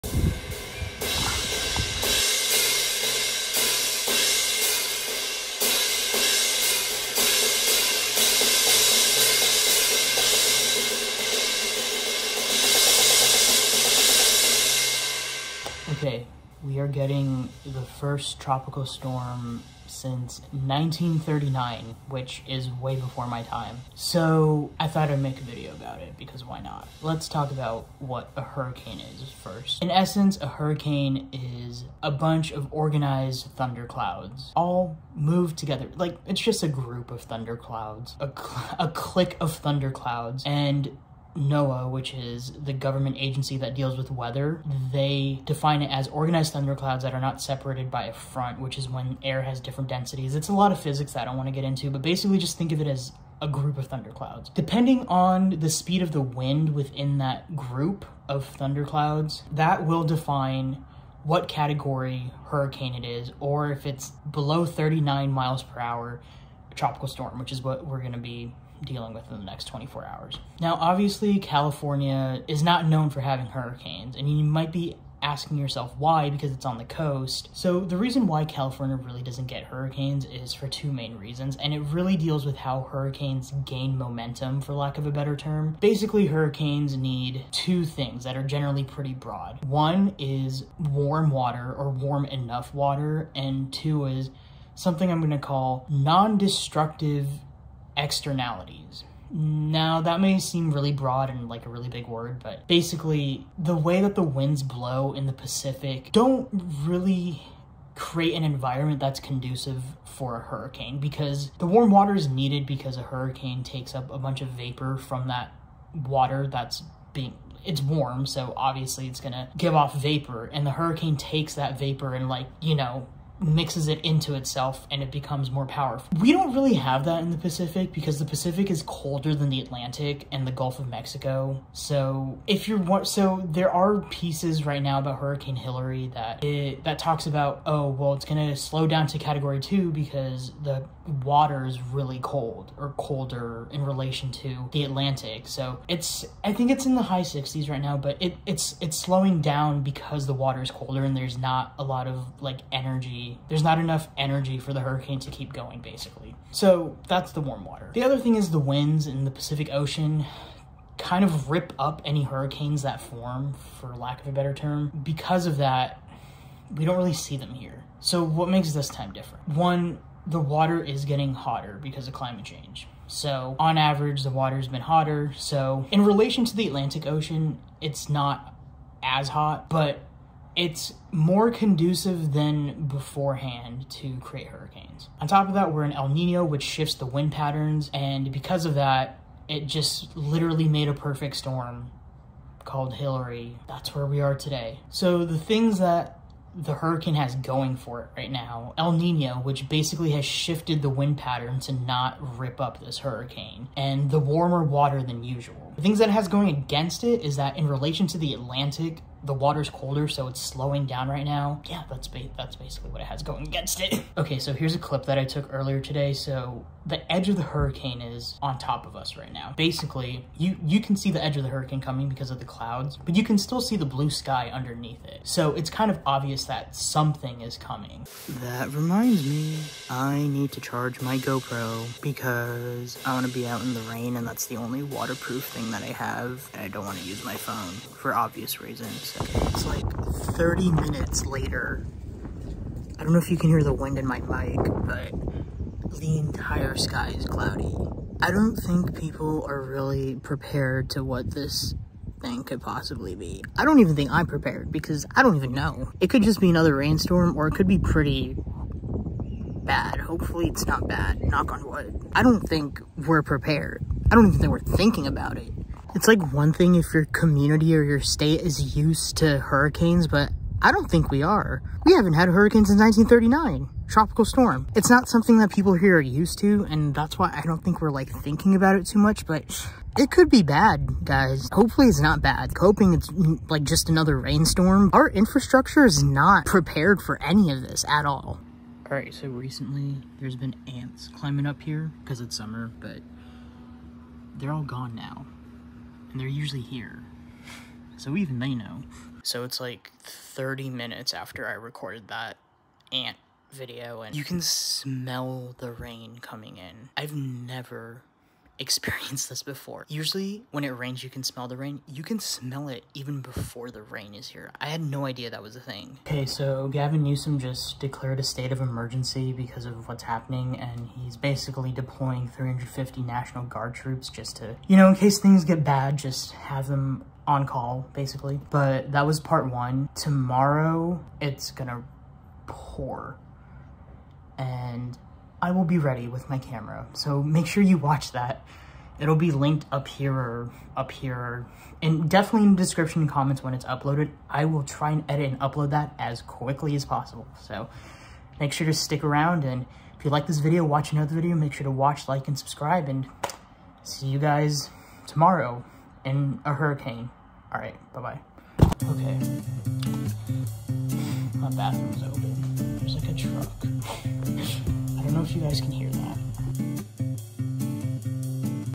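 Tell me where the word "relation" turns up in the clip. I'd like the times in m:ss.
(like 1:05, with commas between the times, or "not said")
2:23, 2:56, 3:27.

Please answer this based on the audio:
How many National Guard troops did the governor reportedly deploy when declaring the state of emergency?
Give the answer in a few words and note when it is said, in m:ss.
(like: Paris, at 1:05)
350, at 5:22.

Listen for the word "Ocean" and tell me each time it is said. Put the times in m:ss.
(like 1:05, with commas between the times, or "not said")
2:39, 2:57.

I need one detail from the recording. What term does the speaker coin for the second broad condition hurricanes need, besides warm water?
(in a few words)
non-destructive externalities.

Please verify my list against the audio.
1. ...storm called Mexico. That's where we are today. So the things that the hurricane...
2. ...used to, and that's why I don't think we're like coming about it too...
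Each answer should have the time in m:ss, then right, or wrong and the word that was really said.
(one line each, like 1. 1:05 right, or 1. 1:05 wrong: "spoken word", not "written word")
1. 3:11 wrong: "Hilary", not "Mexico"
2. 4:36 wrong: "thinking", not "coming".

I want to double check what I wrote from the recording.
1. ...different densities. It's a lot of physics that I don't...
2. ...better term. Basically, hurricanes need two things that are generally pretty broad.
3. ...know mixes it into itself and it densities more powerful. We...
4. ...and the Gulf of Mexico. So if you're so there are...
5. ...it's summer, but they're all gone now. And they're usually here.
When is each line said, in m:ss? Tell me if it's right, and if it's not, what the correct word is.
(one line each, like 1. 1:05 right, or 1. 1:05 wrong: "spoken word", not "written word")
1. 0:49 right
2. 1:25 right
3. 2:02 wrong: "becomes", not "densities"
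4. 2:10 right
5. 4:52 right.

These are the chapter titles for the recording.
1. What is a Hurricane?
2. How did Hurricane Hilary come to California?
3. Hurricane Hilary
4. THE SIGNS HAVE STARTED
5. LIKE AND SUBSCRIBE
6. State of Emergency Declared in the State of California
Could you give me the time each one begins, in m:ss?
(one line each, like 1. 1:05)
1. 0:15
2. 1:10
3. 3:14
4. 3:33
5. 5:58
6. 5:15.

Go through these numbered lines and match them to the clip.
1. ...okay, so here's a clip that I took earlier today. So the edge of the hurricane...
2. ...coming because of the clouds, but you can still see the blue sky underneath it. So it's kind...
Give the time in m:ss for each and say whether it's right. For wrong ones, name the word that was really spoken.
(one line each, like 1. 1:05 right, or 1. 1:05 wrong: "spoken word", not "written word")
1. 3:34 right
2. 3:41 right.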